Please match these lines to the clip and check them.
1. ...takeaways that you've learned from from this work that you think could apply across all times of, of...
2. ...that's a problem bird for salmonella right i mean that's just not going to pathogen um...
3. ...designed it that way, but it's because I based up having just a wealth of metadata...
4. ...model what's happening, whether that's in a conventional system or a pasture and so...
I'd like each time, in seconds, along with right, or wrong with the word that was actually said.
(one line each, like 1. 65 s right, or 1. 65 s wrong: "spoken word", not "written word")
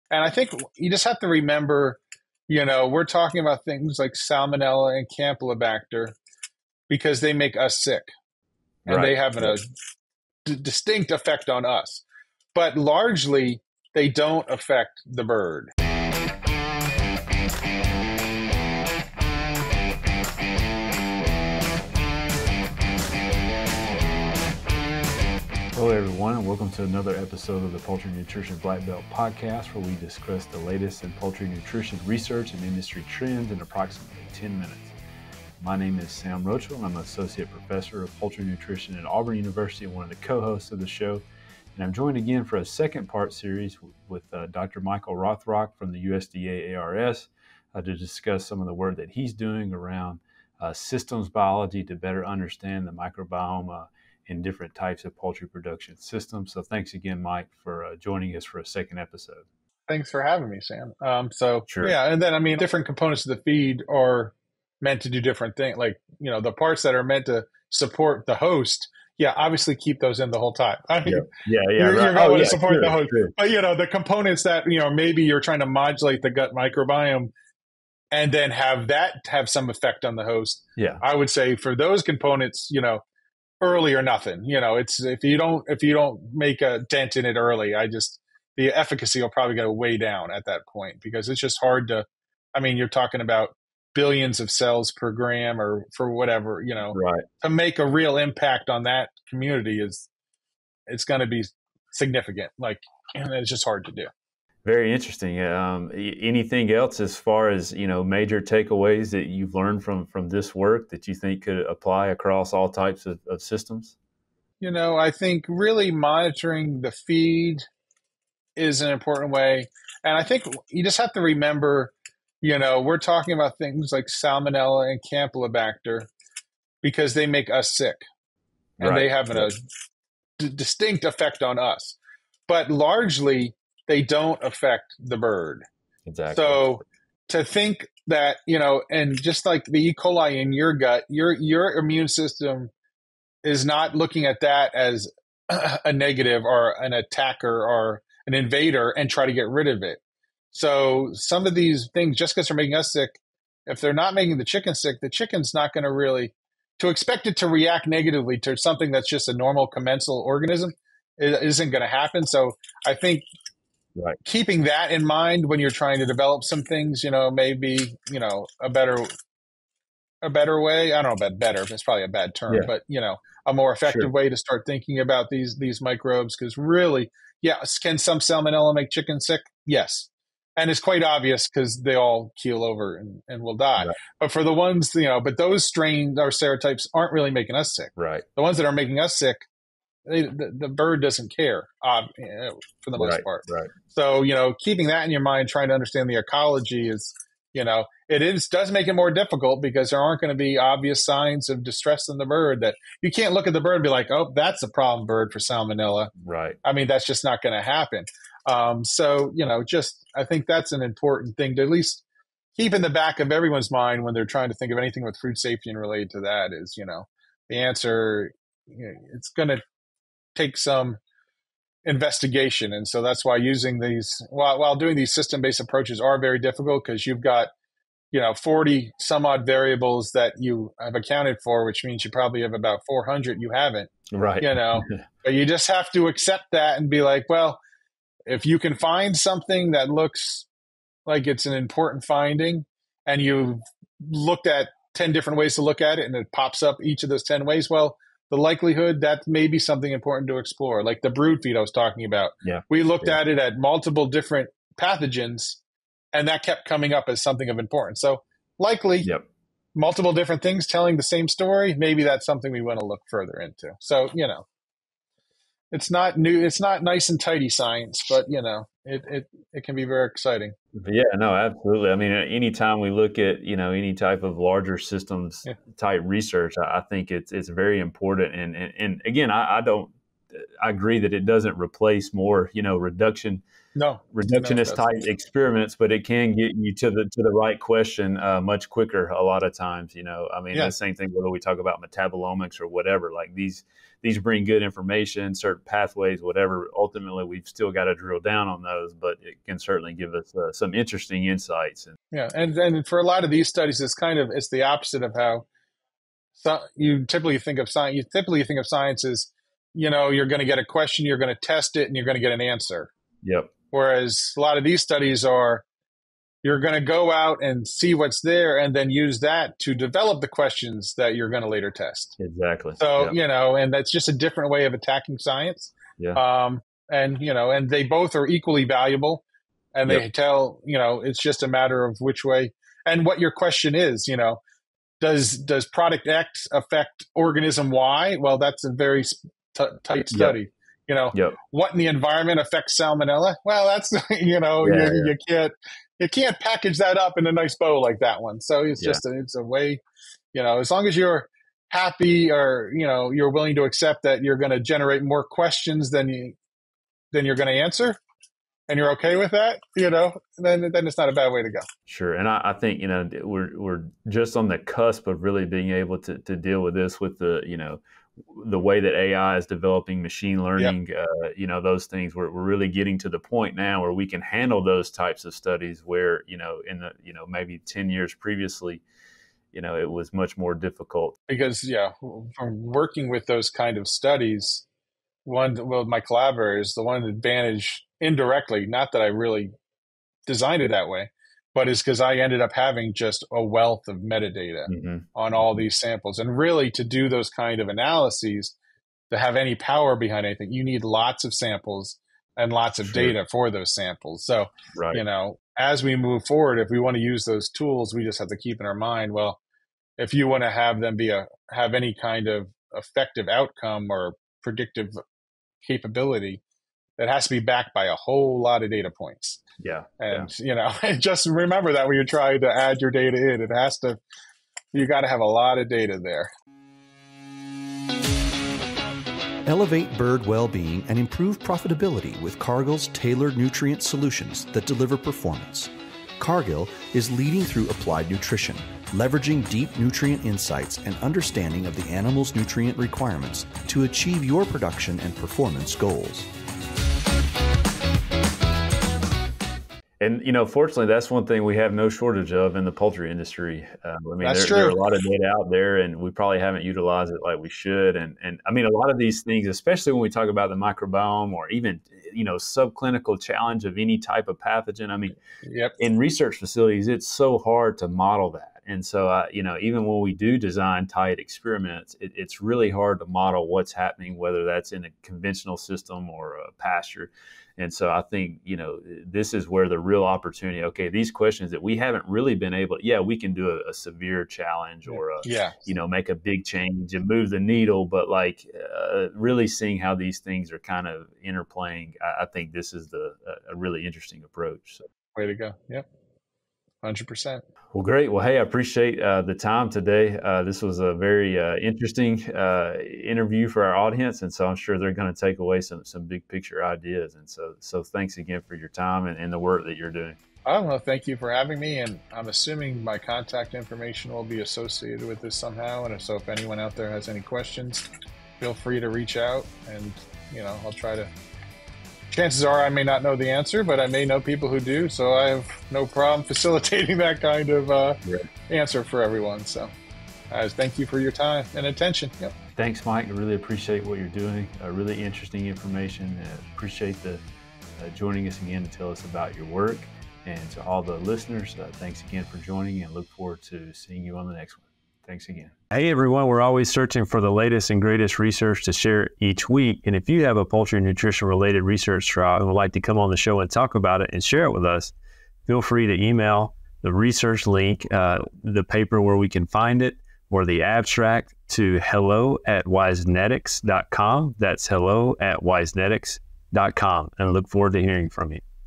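1. 108 s wrong: "types", not "times"
2. 204 s wrong: "happen", not "pathogen"
3. 390 s wrong: "ended", not "based"
4. 473 s right.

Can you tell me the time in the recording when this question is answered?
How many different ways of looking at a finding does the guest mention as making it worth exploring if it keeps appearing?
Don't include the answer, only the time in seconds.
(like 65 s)
244 s.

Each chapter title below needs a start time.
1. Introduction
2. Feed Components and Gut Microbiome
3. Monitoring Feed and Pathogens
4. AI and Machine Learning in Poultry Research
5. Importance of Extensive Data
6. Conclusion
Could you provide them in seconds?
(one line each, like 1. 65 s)
1. 26 s
2. 63 s
3. 114 s
4. 362 s
5. 441 s
6. 474 s.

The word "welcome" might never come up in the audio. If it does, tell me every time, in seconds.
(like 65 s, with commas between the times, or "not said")
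26 s.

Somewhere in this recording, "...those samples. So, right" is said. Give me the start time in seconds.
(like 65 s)
403 s.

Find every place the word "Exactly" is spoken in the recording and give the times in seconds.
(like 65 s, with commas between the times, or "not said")
136 s, 322 s.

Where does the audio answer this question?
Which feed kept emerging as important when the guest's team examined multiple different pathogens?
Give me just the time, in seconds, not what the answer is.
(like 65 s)
251 s.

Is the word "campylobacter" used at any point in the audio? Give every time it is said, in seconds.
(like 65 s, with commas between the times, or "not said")
5 s, 125 s.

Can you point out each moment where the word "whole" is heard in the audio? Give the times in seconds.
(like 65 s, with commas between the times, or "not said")
70 s, 417 s.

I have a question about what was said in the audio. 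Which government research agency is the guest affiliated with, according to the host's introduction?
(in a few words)
USDA ARS.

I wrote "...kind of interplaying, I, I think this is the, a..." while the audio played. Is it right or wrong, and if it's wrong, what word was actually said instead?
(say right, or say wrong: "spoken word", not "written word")
right.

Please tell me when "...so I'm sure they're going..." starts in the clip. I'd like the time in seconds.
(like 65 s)
504 s.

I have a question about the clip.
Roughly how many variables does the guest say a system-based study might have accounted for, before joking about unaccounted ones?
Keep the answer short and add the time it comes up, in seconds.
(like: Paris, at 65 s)
40, at 228 s.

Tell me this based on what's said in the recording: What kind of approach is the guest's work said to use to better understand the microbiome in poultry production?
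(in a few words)
systems biology.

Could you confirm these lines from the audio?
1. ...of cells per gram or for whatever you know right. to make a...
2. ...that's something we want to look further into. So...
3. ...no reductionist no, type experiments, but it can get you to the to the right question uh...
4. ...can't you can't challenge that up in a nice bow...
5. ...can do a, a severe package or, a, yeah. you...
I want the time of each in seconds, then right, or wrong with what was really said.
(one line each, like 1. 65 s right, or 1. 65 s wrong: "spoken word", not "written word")
1. 94 s right
2. 262 s right
3. 283 s right
4. 345 s wrong: "package", not "challenge"
5. 483 s wrong: "challenge", not "package".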